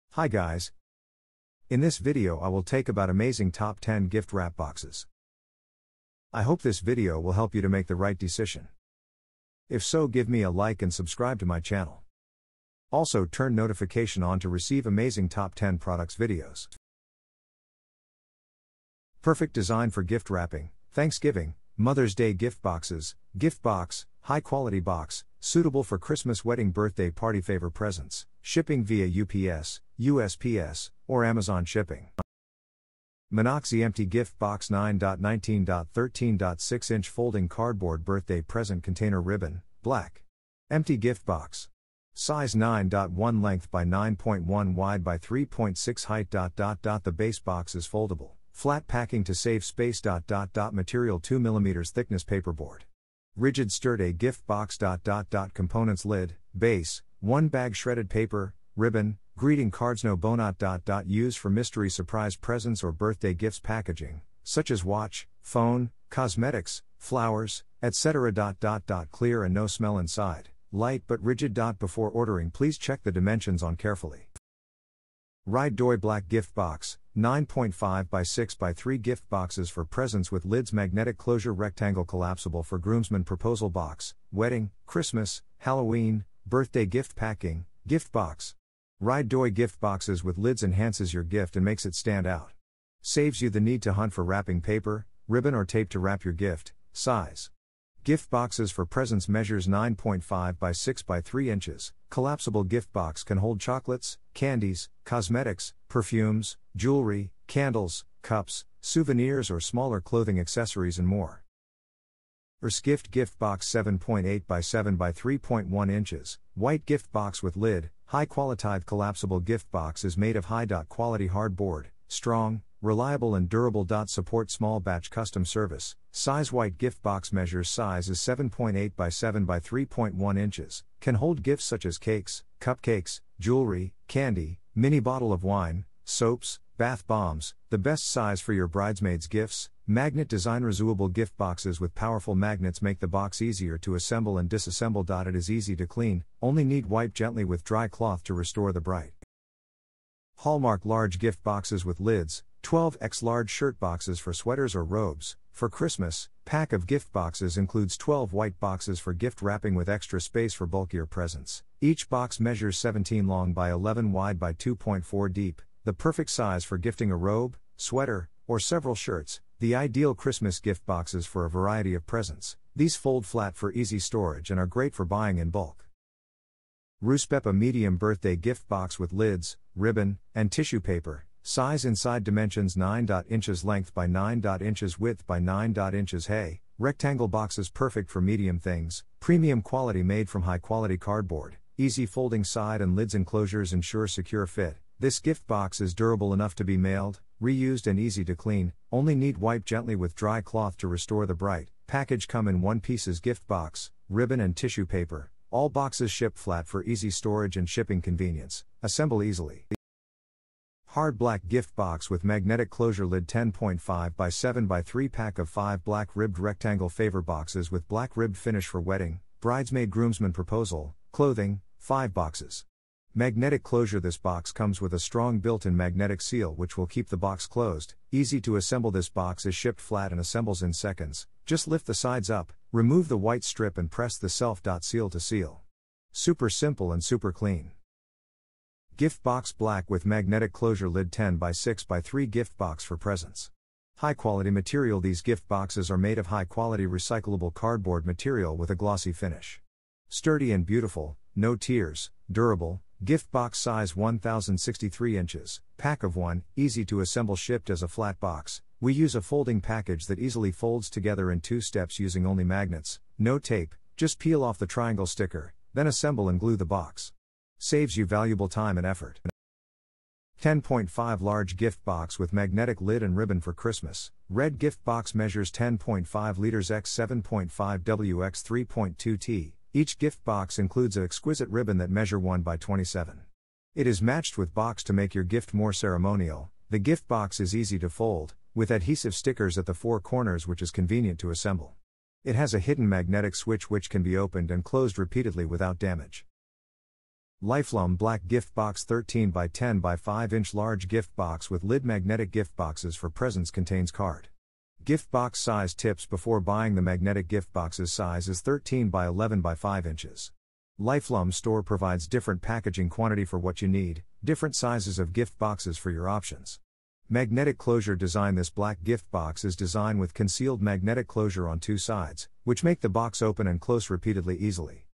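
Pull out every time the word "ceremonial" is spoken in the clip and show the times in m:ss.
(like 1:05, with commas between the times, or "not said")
4:45.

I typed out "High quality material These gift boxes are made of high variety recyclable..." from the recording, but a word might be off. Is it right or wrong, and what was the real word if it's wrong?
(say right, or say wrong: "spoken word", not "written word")
wrong: "quality", not "variety".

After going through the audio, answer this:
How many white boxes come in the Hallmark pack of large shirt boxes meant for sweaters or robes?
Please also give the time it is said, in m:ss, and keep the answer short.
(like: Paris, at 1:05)
12, at 2:37.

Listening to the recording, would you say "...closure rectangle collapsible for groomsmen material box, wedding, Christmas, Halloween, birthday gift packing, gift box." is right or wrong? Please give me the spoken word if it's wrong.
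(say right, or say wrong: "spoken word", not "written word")
wrong: "proposal", not "material".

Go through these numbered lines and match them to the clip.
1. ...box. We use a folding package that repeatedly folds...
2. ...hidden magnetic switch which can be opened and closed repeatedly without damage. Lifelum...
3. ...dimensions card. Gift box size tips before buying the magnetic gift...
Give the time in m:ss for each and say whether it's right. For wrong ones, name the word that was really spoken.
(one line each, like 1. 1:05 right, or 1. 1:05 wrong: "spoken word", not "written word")
1. 4:18 wrong: "easily", not "repeatedly"
2. 4:52 right
3. 5:03 wrong: "contains", not "dimensions".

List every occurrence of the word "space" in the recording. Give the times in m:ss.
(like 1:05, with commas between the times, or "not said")
0:49, 2:40.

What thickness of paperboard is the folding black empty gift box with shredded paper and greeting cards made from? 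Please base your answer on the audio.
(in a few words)
2 mm.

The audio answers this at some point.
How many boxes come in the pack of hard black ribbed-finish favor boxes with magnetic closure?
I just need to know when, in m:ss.
3:35.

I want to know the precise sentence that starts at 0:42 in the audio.
Size 9.1 length by 9.1 wide by 3.6 height.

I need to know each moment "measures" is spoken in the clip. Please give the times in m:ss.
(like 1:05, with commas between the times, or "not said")
1:39, 2:07, 2:42, 4:35, 4:41.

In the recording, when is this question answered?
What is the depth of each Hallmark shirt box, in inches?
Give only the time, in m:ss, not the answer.
2:44.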